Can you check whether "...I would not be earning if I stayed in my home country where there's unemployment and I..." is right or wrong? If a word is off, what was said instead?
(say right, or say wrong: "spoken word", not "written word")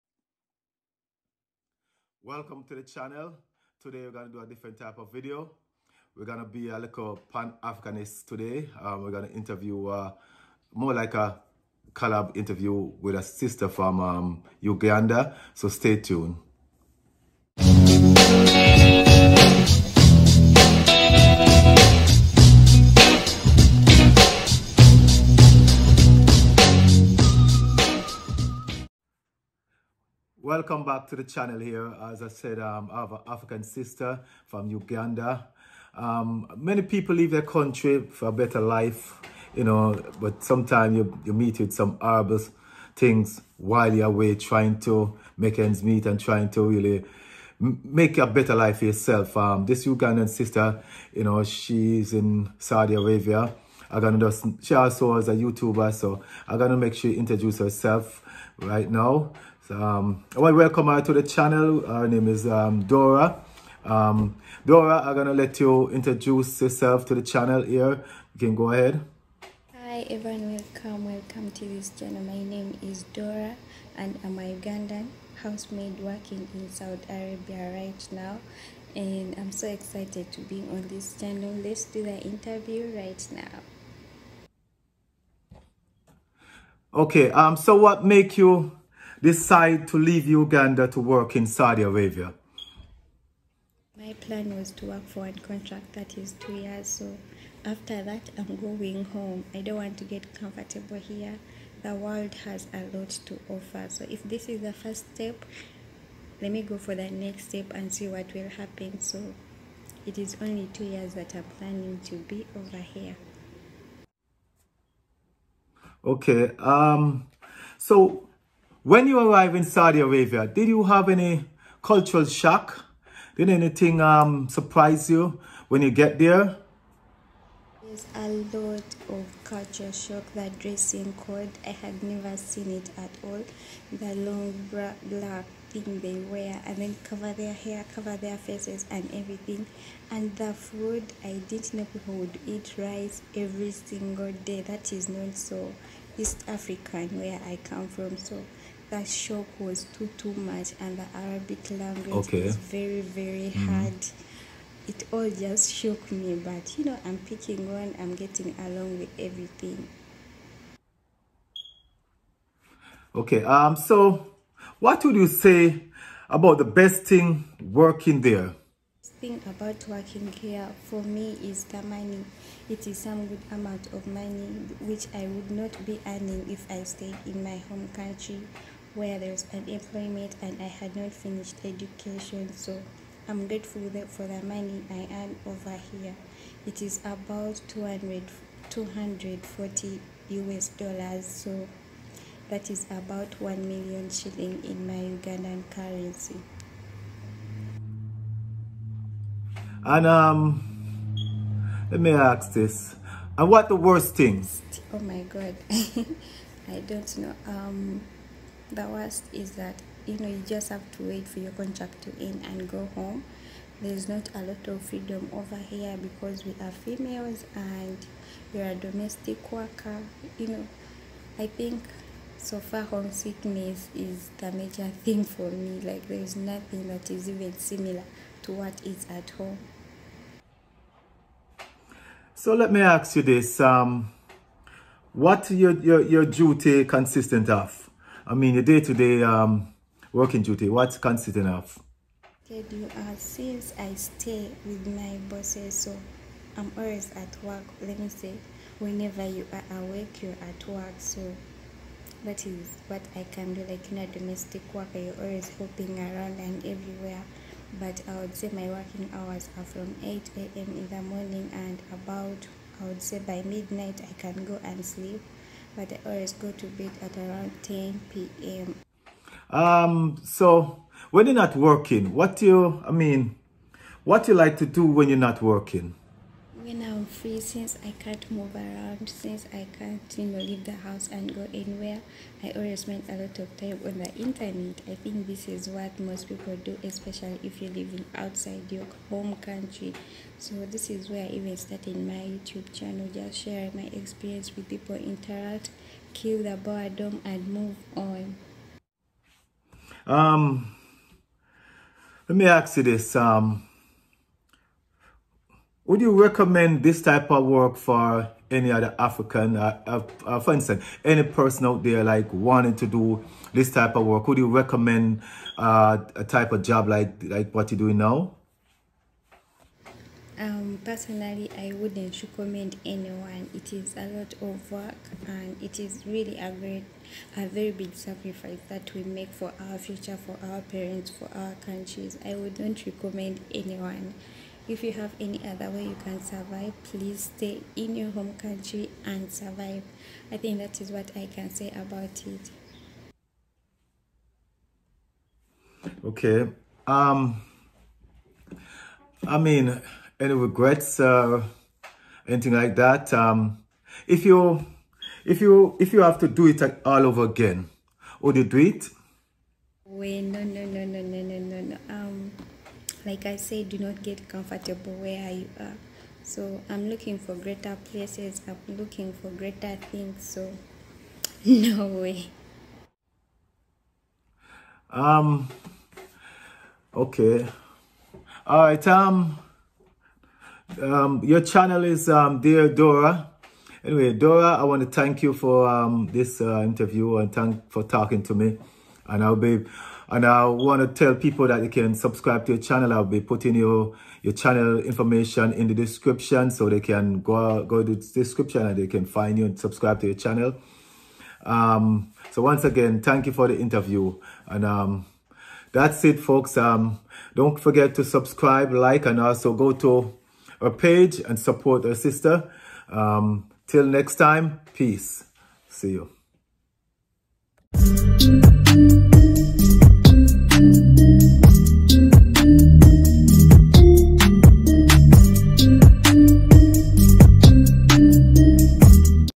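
right.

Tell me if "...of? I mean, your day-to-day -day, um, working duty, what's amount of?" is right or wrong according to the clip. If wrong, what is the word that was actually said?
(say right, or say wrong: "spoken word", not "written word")
wrong: "consistent", not "amount".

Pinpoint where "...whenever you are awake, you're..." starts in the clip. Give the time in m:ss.
4:08.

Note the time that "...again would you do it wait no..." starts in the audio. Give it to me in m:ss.
5:57.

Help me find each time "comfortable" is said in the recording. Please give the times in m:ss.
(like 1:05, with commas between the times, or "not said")
1:40, 6:04.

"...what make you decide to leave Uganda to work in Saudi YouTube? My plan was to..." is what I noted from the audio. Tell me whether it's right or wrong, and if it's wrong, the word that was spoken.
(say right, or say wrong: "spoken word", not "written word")
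wrong: "Arabia", not "YouTube".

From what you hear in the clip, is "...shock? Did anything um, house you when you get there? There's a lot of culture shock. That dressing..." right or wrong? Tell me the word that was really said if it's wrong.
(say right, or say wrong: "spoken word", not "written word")
wrong: "surprise", not "house".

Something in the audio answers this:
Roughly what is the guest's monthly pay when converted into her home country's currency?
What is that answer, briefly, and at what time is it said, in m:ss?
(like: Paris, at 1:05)
1 million shillings, at 3:13.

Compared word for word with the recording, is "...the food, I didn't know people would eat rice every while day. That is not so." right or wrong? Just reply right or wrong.
wrong.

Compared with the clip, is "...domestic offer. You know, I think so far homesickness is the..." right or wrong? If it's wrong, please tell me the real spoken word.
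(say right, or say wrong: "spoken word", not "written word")
wrong: "worker", not "offer".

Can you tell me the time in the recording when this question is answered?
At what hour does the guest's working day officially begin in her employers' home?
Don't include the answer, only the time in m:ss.
4:20.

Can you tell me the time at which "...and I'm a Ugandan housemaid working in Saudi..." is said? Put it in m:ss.
1:13.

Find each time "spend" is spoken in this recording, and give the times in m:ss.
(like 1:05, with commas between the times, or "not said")
4:42.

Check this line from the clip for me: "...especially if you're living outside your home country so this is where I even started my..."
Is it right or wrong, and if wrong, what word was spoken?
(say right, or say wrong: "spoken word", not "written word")
right.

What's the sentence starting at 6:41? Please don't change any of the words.
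Um, so once again, thank you for the interview.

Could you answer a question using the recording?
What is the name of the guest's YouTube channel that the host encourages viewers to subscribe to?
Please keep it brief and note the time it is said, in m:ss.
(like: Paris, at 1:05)
Dear Dora, at 6:22.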